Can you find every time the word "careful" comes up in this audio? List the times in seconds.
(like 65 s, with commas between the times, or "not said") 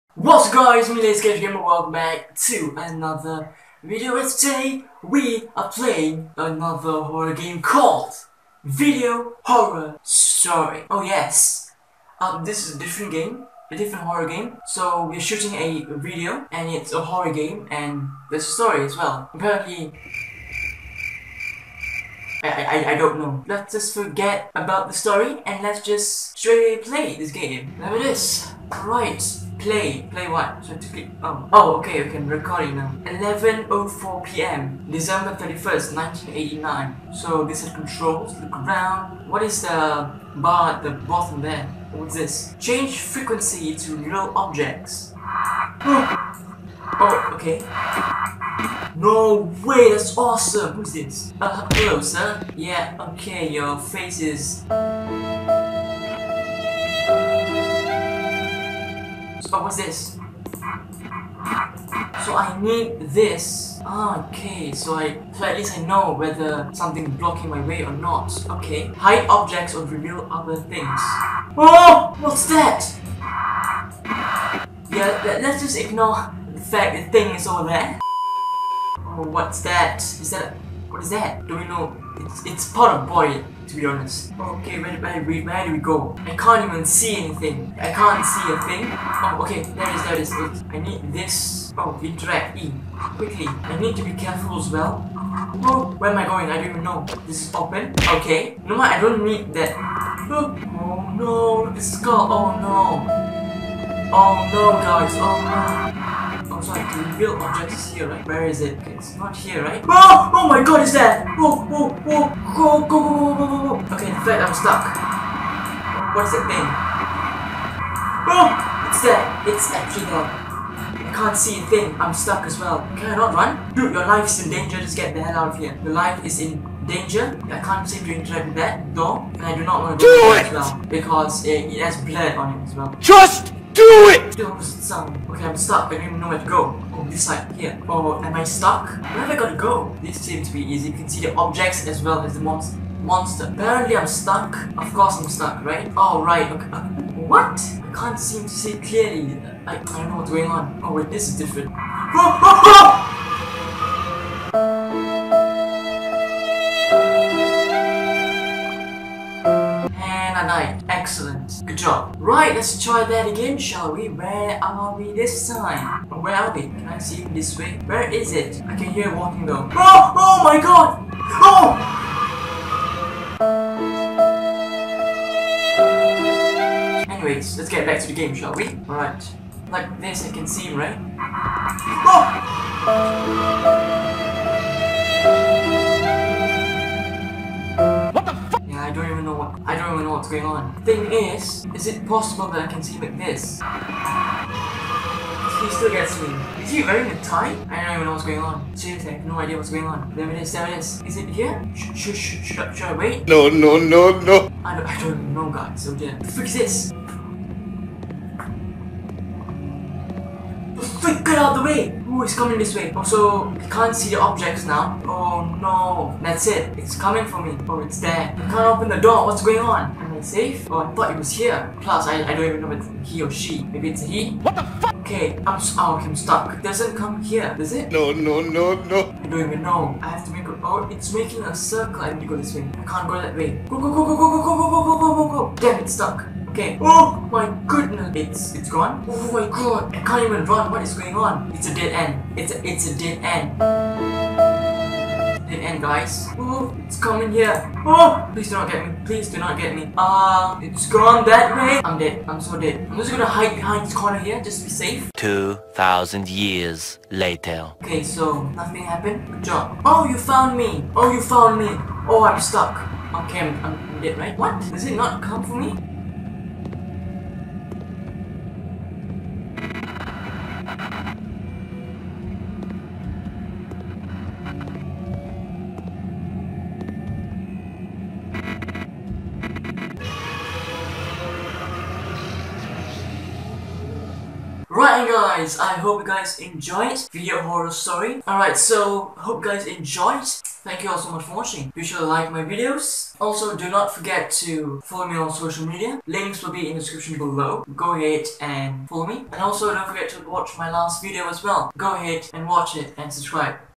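94 s.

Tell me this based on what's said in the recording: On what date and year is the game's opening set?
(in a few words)
December 31st, 1989.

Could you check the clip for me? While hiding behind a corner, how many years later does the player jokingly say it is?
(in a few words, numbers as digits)
2000.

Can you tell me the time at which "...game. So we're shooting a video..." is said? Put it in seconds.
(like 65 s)
14 s.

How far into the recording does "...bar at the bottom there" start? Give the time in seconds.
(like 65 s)
40 s.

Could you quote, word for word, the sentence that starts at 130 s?
Because it, it has blood on it as well.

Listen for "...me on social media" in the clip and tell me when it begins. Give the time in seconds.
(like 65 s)
295 s.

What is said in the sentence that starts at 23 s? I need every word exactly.
Let's just forget about the story and let's just straight play this game.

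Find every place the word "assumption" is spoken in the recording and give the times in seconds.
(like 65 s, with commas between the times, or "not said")
not said.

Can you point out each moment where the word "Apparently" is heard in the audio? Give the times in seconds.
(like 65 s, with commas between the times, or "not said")
19 s, 143 s.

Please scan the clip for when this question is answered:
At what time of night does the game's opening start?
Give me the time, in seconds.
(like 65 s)
33 s.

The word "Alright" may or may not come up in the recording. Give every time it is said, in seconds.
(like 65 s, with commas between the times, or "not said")
178 s, 288 s.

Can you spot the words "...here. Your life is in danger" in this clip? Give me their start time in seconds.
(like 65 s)
125 s.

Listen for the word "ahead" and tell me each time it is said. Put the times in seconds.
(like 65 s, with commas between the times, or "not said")
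297 s, 301 s.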